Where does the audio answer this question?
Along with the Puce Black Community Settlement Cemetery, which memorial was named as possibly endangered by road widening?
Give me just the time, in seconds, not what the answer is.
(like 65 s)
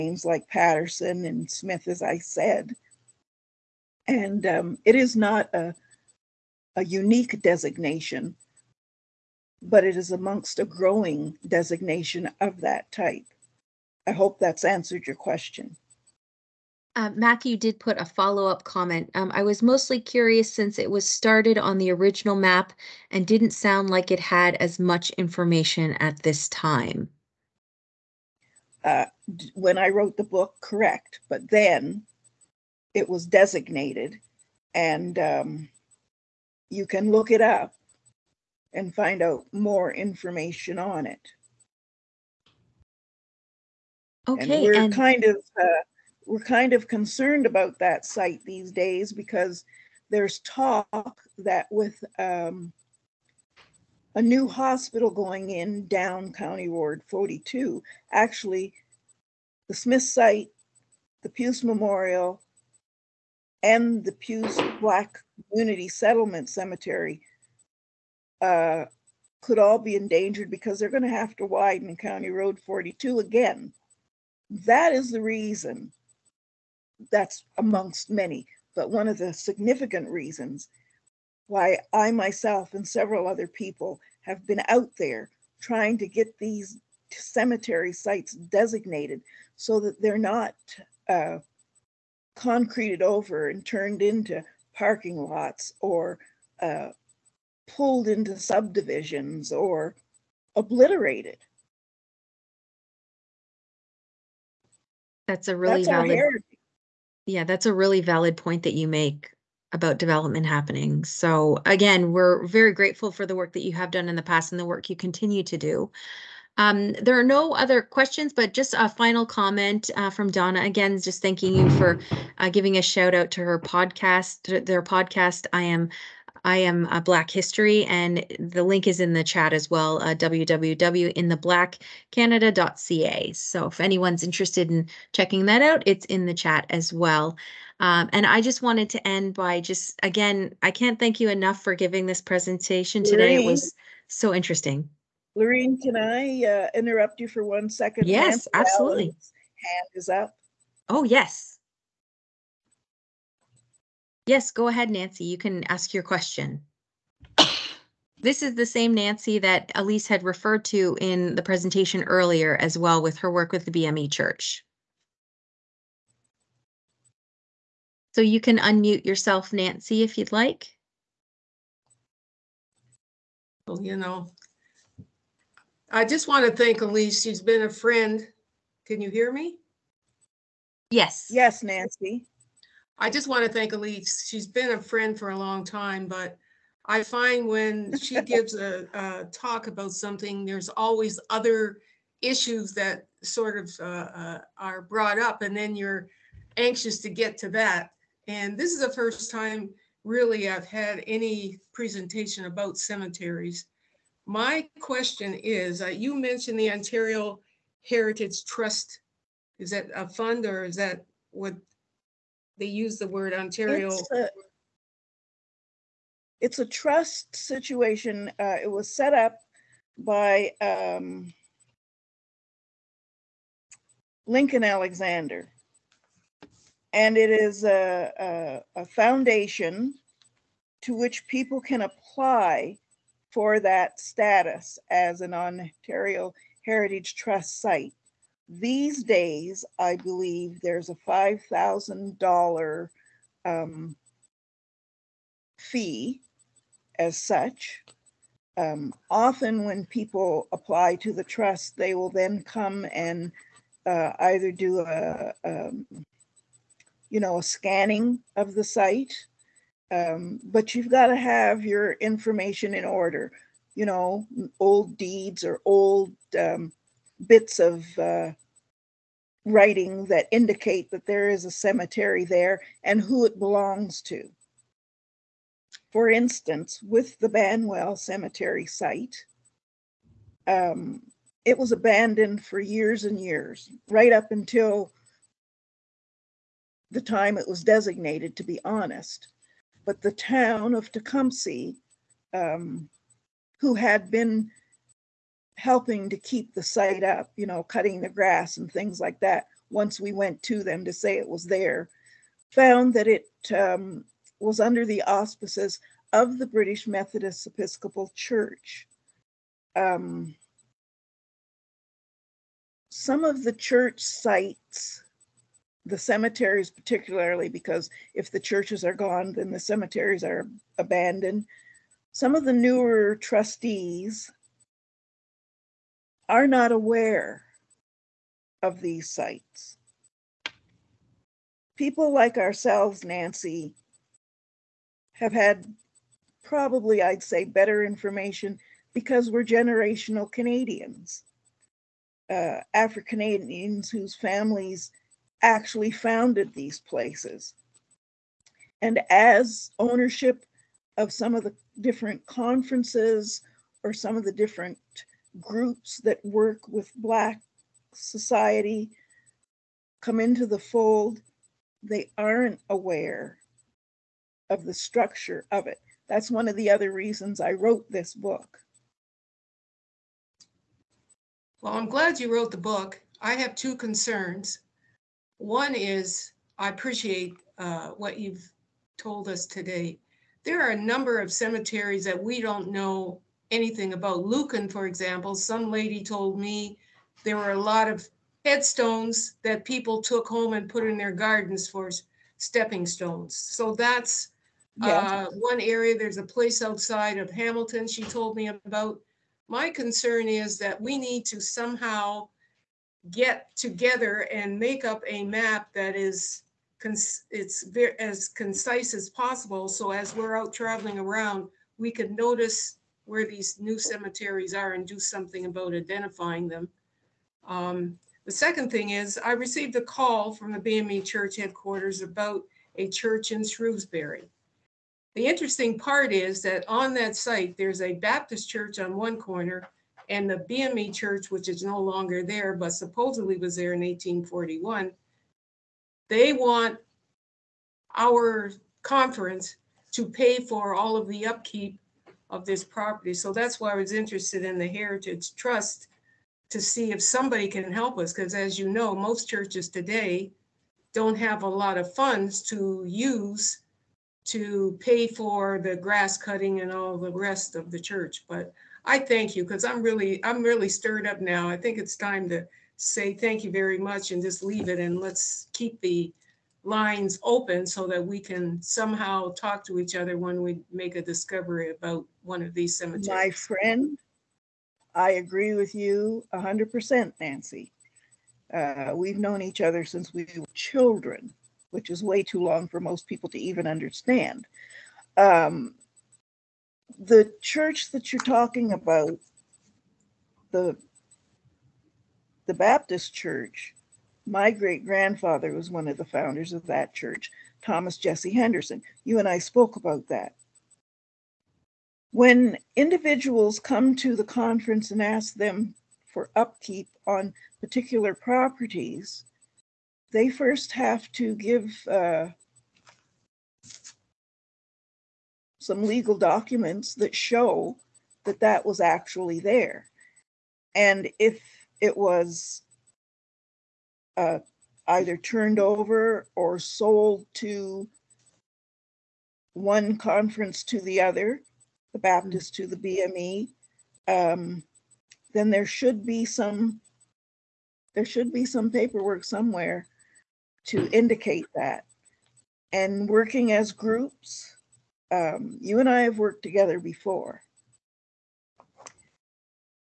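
61 s.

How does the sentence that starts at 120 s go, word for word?
Again, just thanking you for uh, giving a shout out to her podcast, their podcast.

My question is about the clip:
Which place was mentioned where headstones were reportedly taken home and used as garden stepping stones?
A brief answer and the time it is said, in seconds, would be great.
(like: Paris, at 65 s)
Lucan, at 384 s.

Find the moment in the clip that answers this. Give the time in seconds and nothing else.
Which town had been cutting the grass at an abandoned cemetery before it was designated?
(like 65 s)
290 s.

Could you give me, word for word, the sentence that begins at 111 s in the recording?
So again, we're very grateful for the work that you have done in the past and the work you continue to do.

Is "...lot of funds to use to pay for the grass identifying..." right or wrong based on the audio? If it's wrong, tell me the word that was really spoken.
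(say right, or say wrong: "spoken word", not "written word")
wrong: "cutting", not "identifying".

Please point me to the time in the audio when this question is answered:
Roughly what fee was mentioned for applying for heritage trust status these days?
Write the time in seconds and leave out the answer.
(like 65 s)
241 s.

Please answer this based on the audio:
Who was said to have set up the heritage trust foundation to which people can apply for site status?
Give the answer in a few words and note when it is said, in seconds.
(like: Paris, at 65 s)
Lincoln Alexander, at 224 s.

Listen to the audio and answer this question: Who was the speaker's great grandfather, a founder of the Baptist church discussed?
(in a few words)
Thomas Jesse Henderson.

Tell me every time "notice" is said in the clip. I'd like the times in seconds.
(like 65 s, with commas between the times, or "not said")
412 s.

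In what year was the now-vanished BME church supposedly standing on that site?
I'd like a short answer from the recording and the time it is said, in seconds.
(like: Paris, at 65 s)
1841, at 433 s.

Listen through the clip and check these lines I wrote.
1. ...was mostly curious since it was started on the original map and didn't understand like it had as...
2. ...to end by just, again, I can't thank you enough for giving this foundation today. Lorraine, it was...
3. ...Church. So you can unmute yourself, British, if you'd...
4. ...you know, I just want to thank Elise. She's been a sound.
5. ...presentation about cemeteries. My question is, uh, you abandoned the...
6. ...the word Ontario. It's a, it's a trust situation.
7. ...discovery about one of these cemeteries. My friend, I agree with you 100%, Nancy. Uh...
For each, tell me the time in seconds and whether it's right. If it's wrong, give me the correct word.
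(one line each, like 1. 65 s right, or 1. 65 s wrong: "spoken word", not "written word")
1. 19 s wrong: "sound", not "understand"
2. 138 s wrong: "presentation", not "foundation"
3. 164 s wrong: "Nancy", not "British"
4. 173 s wrong: "friend", not "sound"
5. 201 s wrong: "mentioned", not "abandoned"
6. 212 s right
7. 471 s right.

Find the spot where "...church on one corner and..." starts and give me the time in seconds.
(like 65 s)
428 s.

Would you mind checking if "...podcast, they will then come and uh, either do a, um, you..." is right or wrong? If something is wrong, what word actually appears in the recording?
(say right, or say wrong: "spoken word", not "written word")
wrong: "trust", not "podcast".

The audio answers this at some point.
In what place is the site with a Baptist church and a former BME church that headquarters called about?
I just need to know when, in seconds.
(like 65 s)
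423 s.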